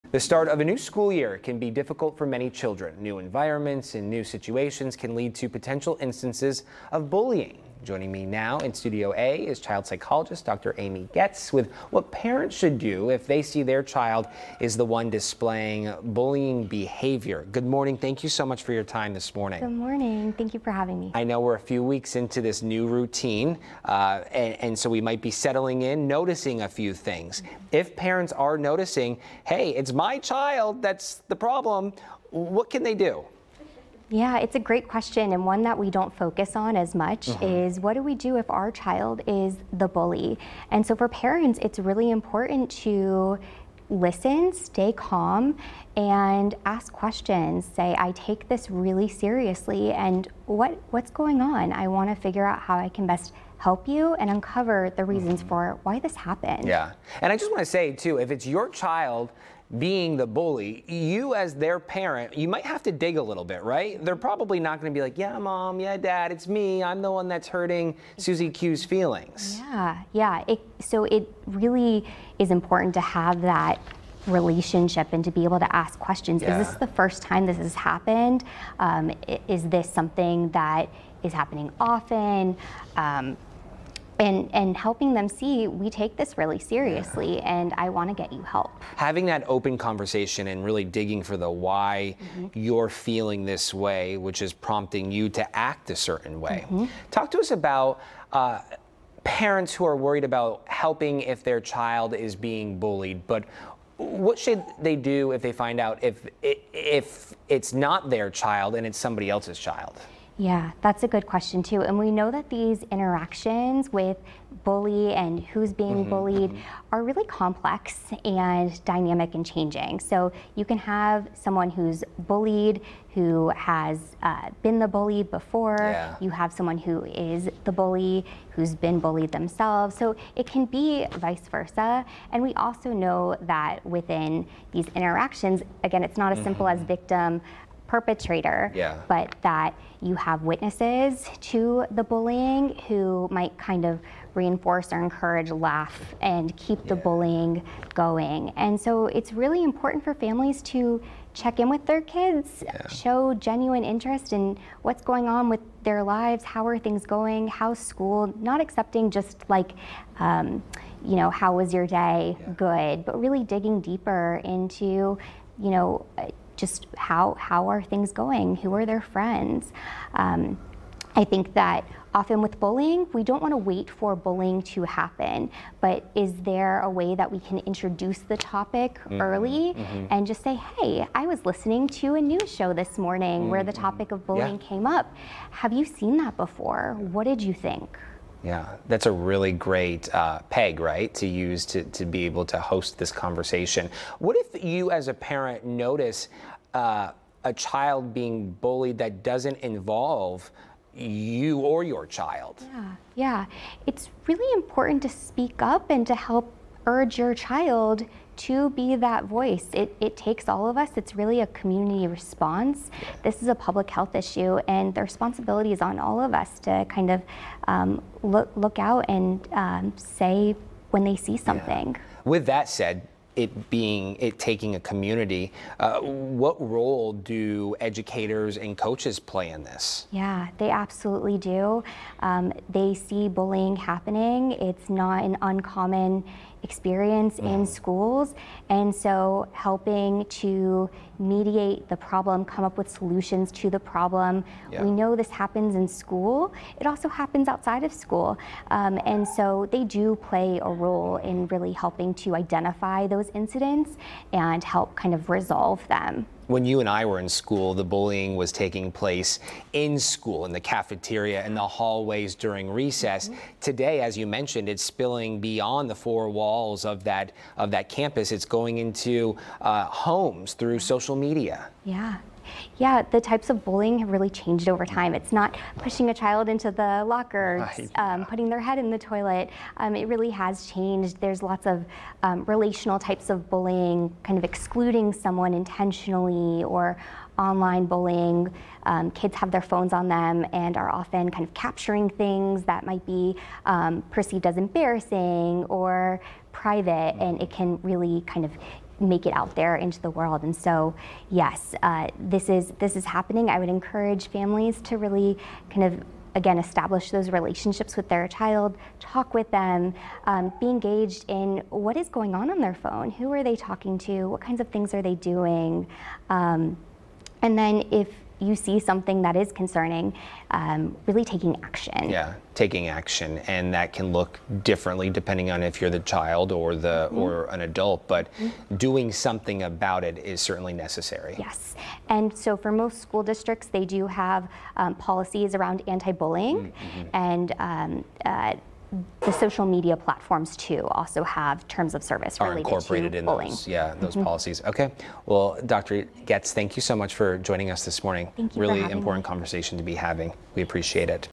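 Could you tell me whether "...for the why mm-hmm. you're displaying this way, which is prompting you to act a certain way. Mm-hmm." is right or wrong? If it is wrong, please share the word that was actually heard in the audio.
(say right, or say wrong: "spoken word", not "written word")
wrong: "feeling", not "displaying".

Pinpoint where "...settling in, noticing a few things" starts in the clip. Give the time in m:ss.
0:25.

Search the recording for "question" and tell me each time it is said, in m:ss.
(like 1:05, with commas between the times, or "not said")
0:34, 0:47, 1:15, 1:51.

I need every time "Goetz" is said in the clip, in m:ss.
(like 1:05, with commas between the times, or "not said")
0:11, 5:46.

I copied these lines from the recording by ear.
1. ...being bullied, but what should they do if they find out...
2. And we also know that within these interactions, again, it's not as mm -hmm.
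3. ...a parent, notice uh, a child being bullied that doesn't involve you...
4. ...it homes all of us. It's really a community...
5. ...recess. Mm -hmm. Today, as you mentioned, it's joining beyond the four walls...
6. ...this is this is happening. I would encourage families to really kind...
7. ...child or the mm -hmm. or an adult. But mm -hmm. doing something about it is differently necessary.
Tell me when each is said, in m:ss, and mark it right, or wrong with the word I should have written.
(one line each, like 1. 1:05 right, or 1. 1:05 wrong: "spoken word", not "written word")
1. 1:42 right
2. 2:12 right
3. 3:15 right
4. 3:30 wrong: "takes", not "homes"
5. 4:22 wrong: "spilling", not "joining"
6. 5:02 right
7. 5:25 wrong: "certainly", not "differently".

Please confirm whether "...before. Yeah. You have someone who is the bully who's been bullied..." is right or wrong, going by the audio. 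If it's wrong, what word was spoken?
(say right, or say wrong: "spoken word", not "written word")
right.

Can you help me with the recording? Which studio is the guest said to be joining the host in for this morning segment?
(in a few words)
Studio A.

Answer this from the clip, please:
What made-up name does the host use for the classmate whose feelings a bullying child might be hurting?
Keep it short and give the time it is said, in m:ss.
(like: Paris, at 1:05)
Susie Q, at 1:08.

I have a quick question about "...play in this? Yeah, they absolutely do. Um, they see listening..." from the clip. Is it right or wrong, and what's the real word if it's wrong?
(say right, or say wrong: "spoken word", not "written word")
wrong: "bullying", not "listening".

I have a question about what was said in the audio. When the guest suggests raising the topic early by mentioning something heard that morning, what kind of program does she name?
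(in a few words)
A news show.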